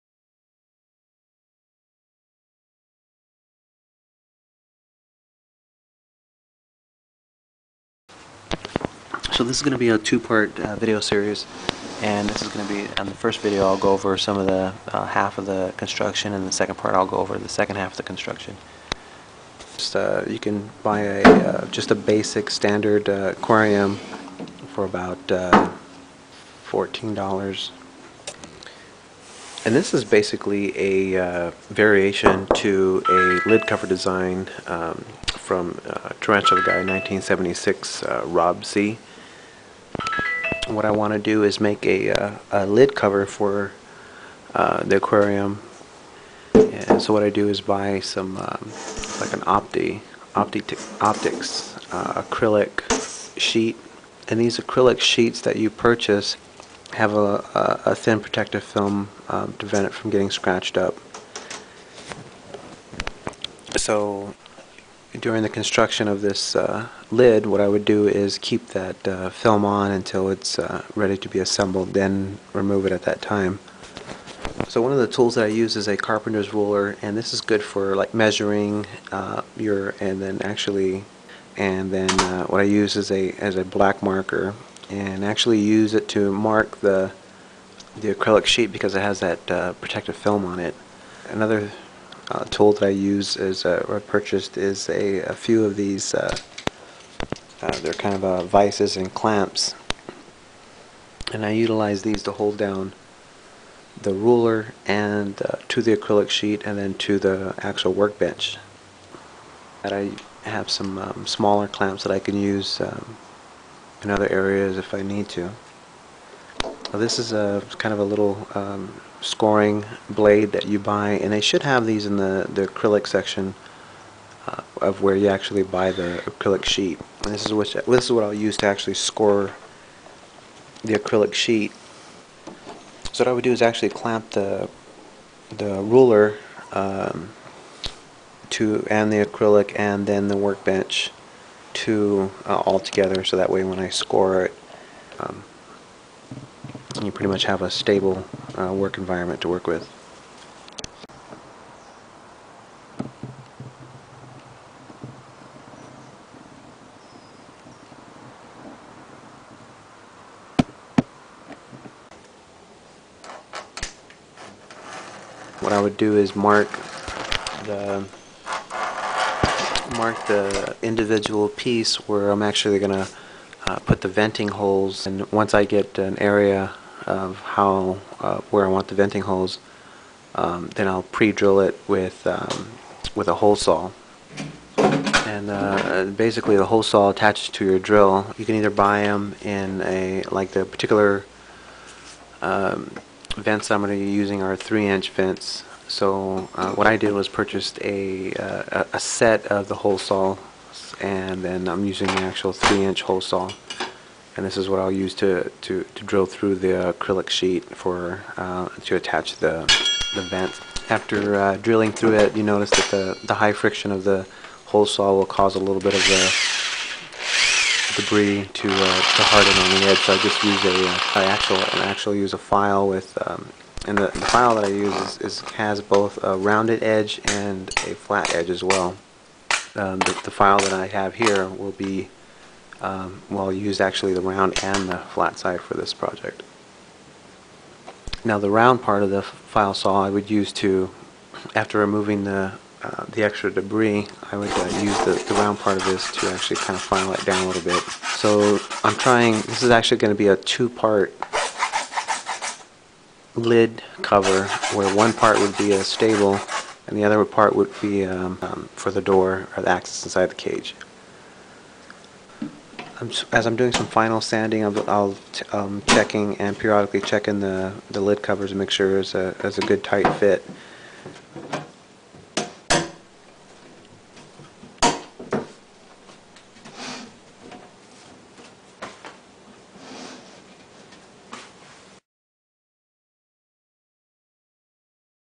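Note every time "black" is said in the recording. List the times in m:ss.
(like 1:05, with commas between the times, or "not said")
1:23.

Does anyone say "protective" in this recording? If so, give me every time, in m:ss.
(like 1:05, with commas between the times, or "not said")
0:58, 1:29.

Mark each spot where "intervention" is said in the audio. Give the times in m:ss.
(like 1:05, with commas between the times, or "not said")
not said.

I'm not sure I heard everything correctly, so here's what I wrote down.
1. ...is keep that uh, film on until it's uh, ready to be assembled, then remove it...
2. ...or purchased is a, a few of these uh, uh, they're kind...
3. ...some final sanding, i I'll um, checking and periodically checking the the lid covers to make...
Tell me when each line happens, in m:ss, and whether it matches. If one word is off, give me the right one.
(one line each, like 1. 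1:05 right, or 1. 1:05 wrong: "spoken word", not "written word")
1. 1:08 right
2. 1:33 right
3. 4:23 right.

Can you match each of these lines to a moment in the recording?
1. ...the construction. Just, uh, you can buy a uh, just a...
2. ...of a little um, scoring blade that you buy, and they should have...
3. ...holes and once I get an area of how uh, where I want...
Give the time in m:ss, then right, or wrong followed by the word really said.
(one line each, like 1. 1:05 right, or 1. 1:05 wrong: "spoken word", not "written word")
1. 0:17 right
2. 1:57 right
3. 2:54 right.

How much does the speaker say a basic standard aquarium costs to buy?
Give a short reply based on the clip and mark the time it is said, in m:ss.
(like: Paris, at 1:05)
$14, at 0:26.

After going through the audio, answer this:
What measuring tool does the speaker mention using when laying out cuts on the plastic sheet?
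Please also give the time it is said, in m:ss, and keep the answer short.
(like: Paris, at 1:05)
carpenter's ruler, at 1:15.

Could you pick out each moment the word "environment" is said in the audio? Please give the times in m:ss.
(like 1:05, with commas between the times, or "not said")
2:28.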